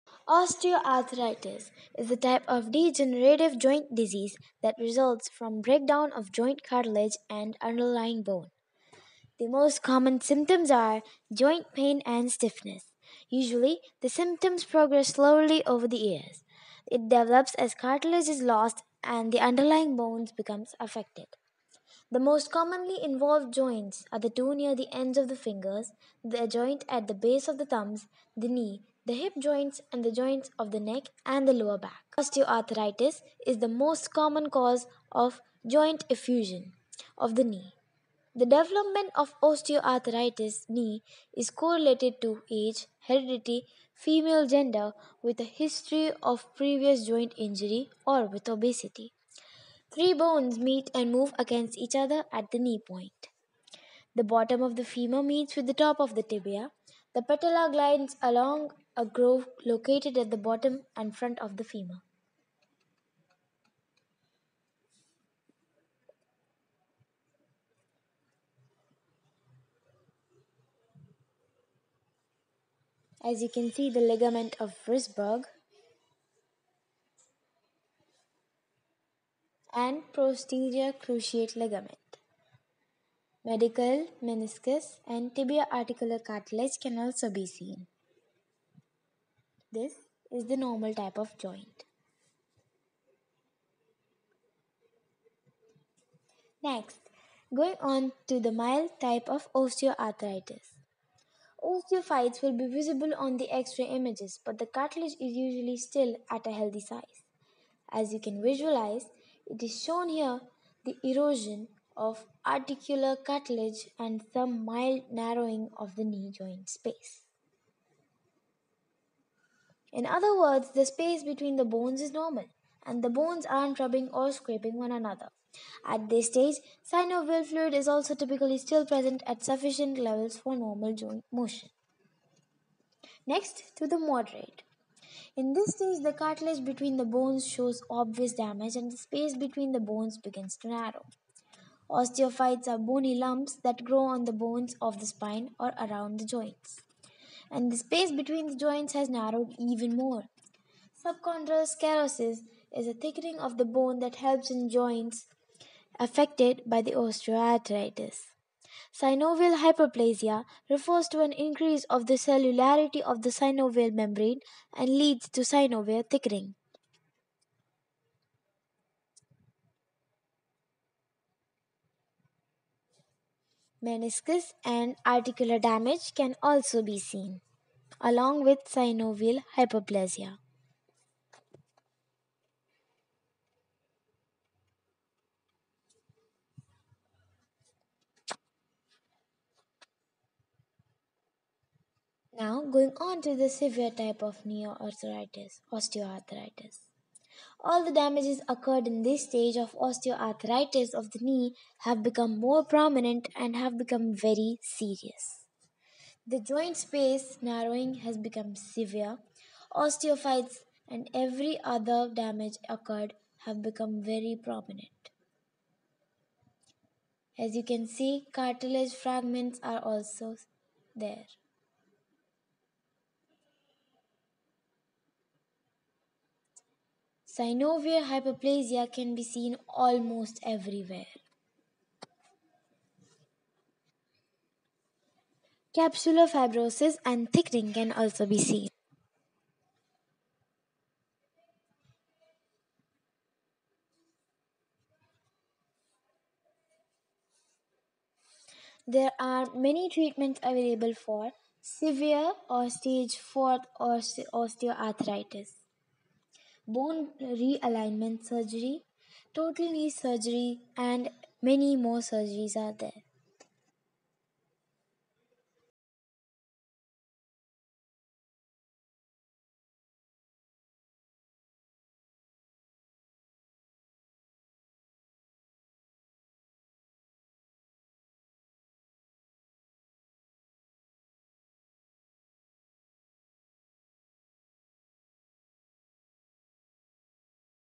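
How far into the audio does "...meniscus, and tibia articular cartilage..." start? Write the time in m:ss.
1:24.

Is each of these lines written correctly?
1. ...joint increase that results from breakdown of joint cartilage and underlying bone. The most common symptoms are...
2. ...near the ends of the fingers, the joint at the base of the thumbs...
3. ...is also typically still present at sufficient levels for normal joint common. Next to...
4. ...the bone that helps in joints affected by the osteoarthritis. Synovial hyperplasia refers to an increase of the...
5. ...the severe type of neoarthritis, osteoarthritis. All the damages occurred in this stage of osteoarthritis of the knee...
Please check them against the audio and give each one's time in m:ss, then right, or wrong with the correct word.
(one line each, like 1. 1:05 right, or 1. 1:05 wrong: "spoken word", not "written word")
1. 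0:03 wrong: "disease", not "increase"
2. 0:24 right
3. 2:07 wrong: "motion", not "common"
4. 2:33 right
5. 3:13 right.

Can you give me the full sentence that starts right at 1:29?
This is the normal type of joint.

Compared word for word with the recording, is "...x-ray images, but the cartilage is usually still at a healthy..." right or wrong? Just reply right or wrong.
right.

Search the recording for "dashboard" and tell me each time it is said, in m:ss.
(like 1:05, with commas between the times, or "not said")
not said.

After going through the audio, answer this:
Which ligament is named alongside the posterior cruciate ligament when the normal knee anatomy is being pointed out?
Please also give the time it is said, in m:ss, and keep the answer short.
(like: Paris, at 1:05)
Ligament of Wrisberg, at 1:13.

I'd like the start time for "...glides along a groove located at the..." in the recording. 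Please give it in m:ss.
0:57.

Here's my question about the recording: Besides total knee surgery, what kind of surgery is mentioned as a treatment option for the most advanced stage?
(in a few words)
Bone realignment surgery.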